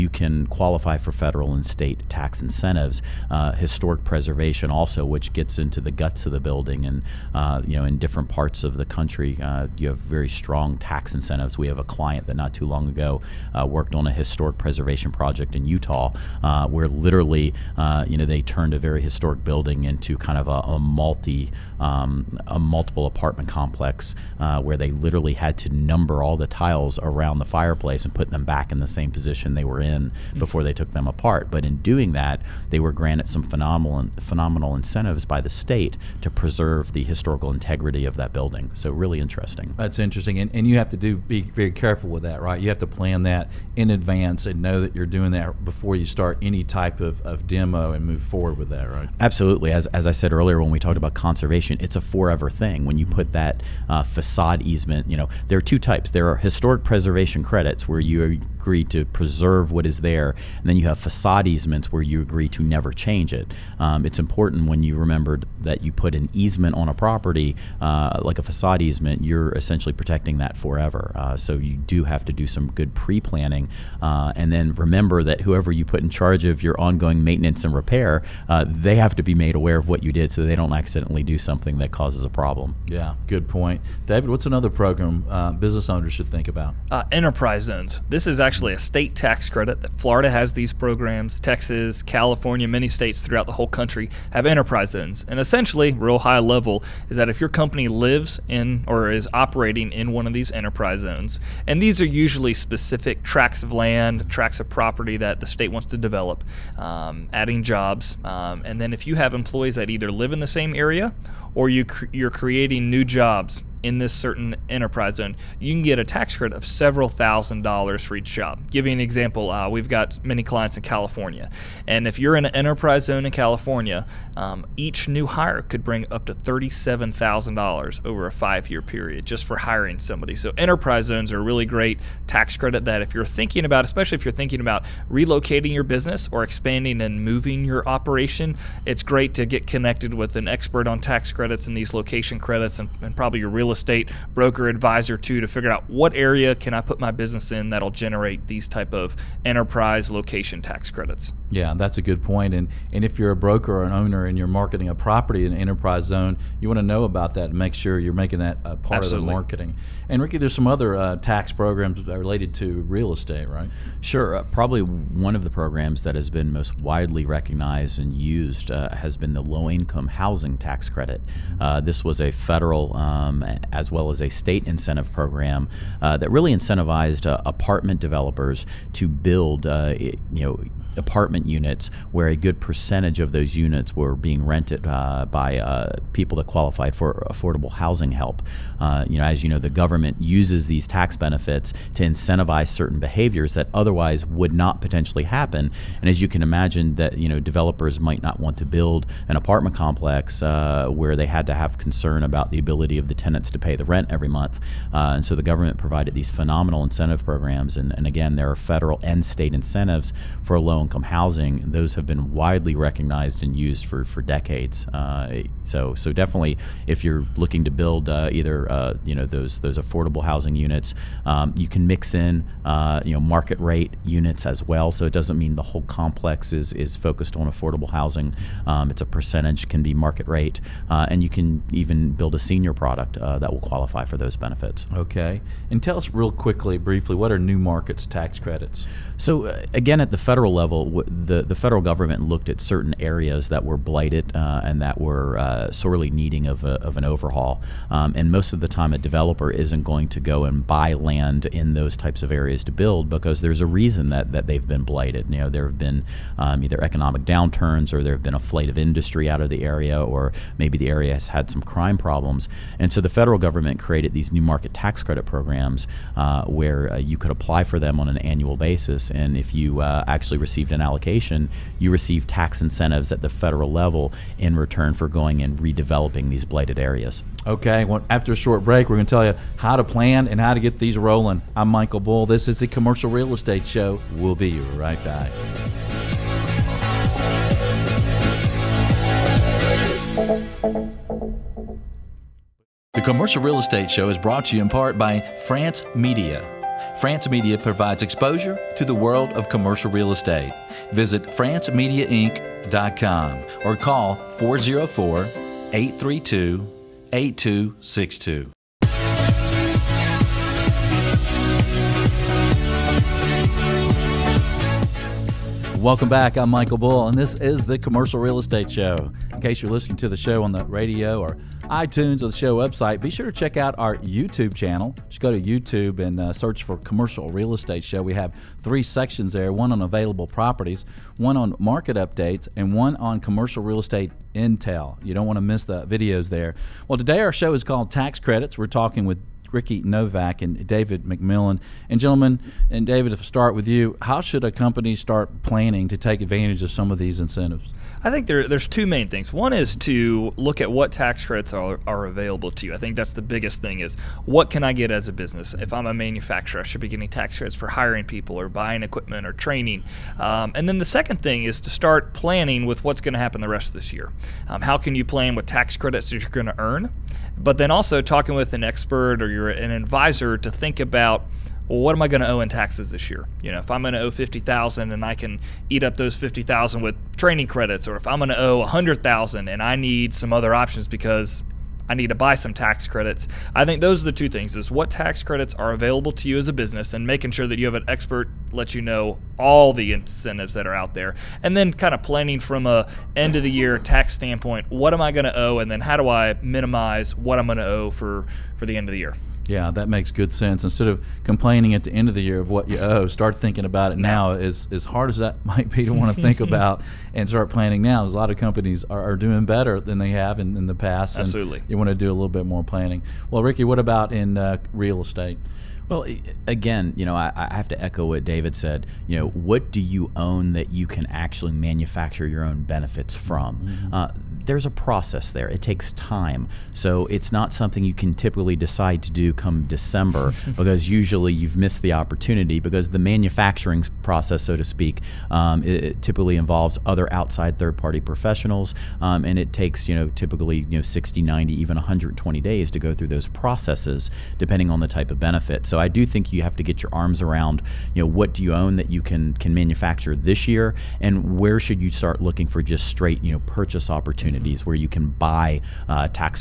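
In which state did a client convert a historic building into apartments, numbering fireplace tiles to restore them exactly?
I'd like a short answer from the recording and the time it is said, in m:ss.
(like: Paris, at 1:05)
Utah, at 0:15.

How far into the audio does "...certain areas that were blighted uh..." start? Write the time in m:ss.
4:02.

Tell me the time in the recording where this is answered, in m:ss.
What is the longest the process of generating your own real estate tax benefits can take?
7:21.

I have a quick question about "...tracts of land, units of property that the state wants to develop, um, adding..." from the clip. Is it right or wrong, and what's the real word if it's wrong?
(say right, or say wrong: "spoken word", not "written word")
wrong: "tracts", not "units".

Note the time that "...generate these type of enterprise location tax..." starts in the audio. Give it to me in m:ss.
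2:27.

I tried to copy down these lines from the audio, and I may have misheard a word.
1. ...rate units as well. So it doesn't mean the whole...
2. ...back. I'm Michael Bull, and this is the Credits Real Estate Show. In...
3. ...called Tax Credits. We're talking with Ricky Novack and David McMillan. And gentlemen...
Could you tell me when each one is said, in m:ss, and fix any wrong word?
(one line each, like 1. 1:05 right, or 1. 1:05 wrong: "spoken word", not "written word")
1. 3:43 right
2. 5:16 wrong: "Commercial", not "Credits"
3. 5:37 right.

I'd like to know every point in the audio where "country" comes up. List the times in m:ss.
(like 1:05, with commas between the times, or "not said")
0:08, 1:33.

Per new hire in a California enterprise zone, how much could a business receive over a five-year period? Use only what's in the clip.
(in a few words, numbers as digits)
$37,000.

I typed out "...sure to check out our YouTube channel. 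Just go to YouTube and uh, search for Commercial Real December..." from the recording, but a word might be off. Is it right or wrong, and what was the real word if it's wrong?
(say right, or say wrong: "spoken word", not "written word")
wrong: "Estate", not "December".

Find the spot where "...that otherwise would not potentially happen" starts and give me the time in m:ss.
3:13.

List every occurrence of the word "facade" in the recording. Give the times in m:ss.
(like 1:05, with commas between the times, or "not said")
0:54, 1:00, 1:08.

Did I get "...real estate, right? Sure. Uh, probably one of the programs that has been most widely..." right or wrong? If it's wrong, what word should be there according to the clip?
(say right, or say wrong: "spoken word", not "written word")
right.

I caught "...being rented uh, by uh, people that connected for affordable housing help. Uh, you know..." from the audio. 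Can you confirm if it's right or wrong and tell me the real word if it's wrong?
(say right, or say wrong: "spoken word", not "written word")
wrong: "qualified", not "connected".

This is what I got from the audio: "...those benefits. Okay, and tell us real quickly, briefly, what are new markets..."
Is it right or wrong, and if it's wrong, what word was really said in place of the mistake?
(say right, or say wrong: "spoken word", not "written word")
right.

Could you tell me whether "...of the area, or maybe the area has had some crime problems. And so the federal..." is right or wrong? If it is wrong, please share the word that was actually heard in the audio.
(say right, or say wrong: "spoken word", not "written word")
right.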